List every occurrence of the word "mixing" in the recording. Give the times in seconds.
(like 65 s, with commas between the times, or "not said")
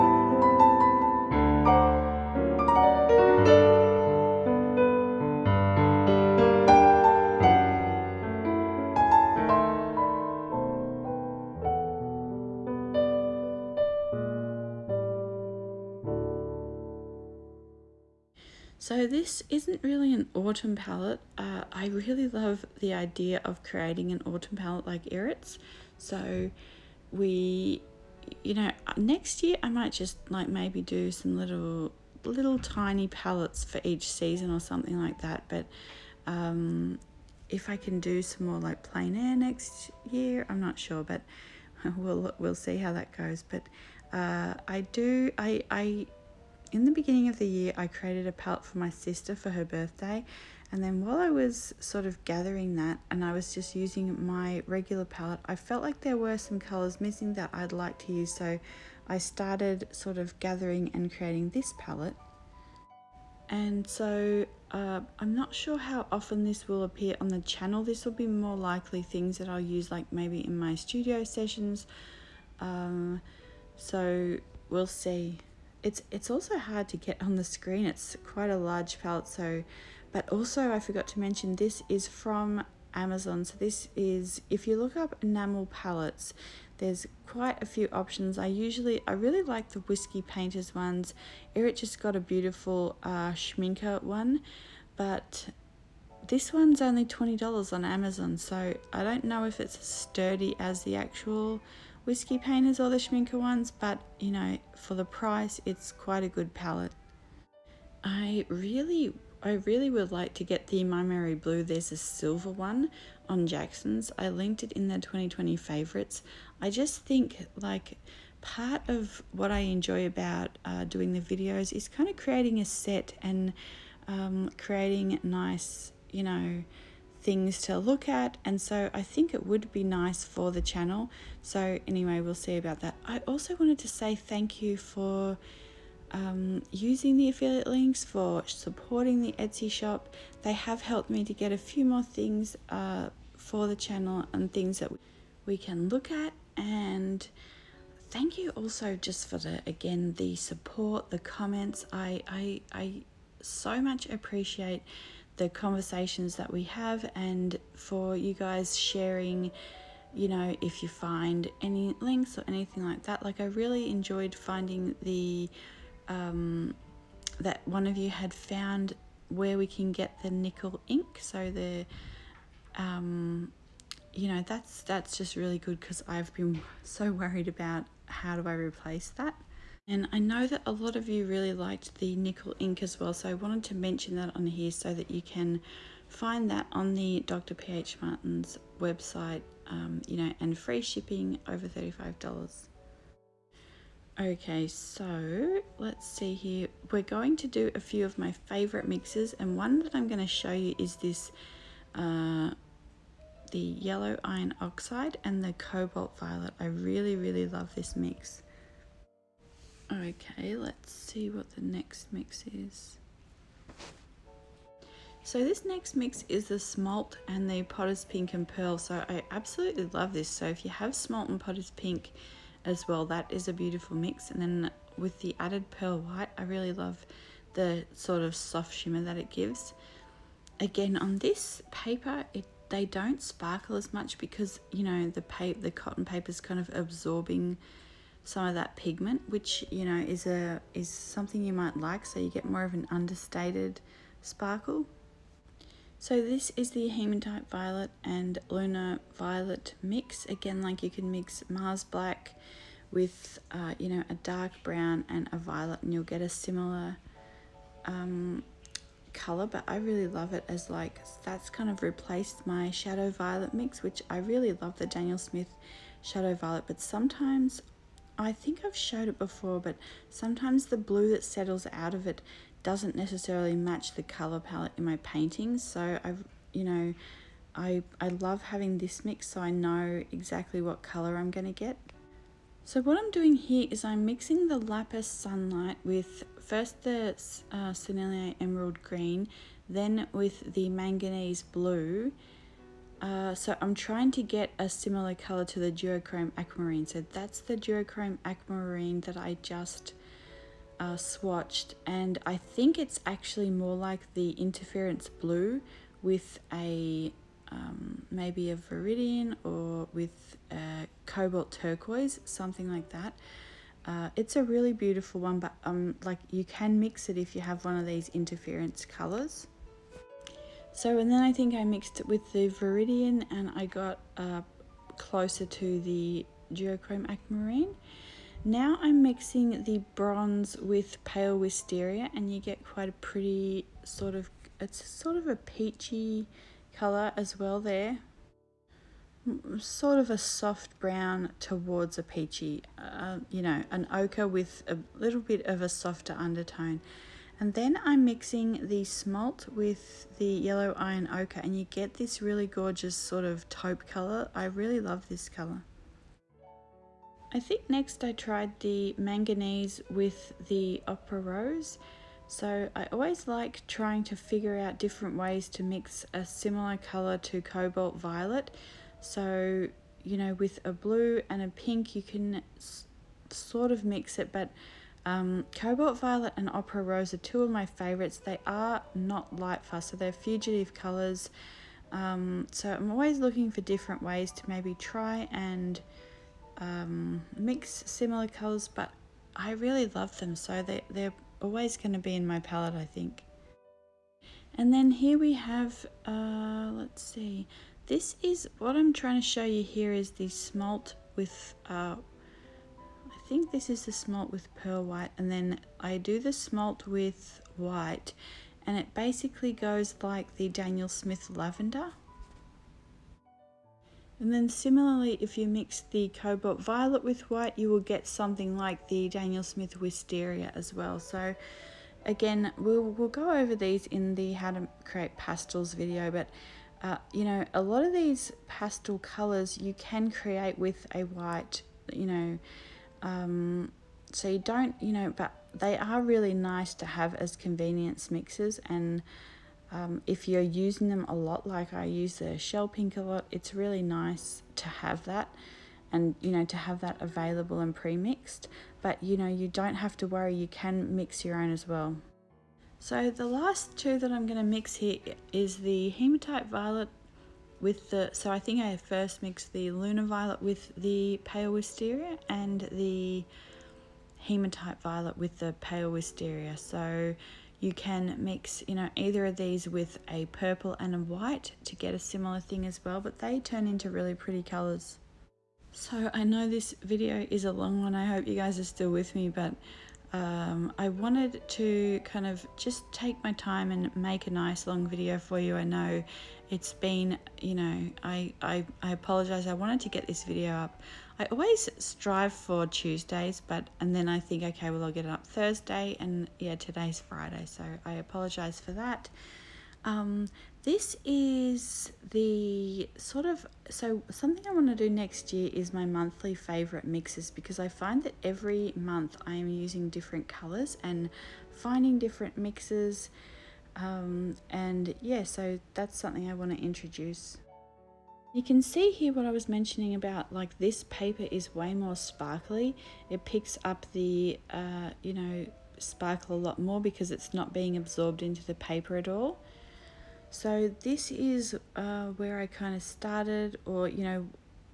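284 s, 329 s, 348 s.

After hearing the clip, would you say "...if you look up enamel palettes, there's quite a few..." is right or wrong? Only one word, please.
right.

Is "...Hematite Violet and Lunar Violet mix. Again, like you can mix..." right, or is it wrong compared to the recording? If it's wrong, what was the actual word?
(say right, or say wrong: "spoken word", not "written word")
right.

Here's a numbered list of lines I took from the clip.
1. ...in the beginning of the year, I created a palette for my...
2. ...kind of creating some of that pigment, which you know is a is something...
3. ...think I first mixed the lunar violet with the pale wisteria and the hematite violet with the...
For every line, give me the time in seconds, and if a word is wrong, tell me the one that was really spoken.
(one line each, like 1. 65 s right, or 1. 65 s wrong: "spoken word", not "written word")
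1. 46 s right
2. 236 s wrong: "absorbing", not "creating"
3. 458 s right.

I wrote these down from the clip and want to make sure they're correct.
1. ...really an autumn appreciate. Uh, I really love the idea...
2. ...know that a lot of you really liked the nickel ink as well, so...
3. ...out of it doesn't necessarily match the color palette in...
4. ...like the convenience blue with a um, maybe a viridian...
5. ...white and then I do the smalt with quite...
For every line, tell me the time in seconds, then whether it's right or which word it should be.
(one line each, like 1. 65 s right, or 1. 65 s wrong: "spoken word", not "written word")
1. 19 s wrong: "palette", not "appreciate"
2. 180 s right
3. 271 s right
4. 303 s wrong: "interference", not "convenience"
5. 404 s wrong: "white", not "quite".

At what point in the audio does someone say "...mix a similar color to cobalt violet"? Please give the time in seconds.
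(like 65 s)
365 s.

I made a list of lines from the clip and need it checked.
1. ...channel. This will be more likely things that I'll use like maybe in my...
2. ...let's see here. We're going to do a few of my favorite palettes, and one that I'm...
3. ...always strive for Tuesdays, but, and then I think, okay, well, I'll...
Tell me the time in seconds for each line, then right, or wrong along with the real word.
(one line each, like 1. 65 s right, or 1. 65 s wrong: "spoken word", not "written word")
1. 67 s right
2. 195 s wrong: "mixes", not "palettes"
3. 491 s right.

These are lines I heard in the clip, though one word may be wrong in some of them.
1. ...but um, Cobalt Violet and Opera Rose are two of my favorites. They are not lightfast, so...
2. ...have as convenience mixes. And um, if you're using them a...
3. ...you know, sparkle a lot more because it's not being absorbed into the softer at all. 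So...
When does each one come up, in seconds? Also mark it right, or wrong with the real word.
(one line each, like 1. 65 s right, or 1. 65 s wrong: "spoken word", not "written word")
1. 374 s right
2. 436 s right
3. 524 s wrong: "paper", not "softer".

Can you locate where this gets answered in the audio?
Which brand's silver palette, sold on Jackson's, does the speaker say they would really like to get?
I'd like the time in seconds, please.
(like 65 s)
110 s.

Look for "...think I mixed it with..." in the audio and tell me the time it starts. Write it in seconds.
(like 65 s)
321 s.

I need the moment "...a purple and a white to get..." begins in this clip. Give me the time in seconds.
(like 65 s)
470 s.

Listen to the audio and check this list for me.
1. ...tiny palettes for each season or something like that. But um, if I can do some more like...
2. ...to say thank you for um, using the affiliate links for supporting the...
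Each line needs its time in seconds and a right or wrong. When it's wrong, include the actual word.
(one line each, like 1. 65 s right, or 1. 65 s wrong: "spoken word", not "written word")
1. 32 s right
2. 133 s right.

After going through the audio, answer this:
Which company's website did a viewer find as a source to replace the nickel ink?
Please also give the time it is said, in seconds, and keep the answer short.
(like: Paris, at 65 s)
Dr. PH Martin's, at 187 s.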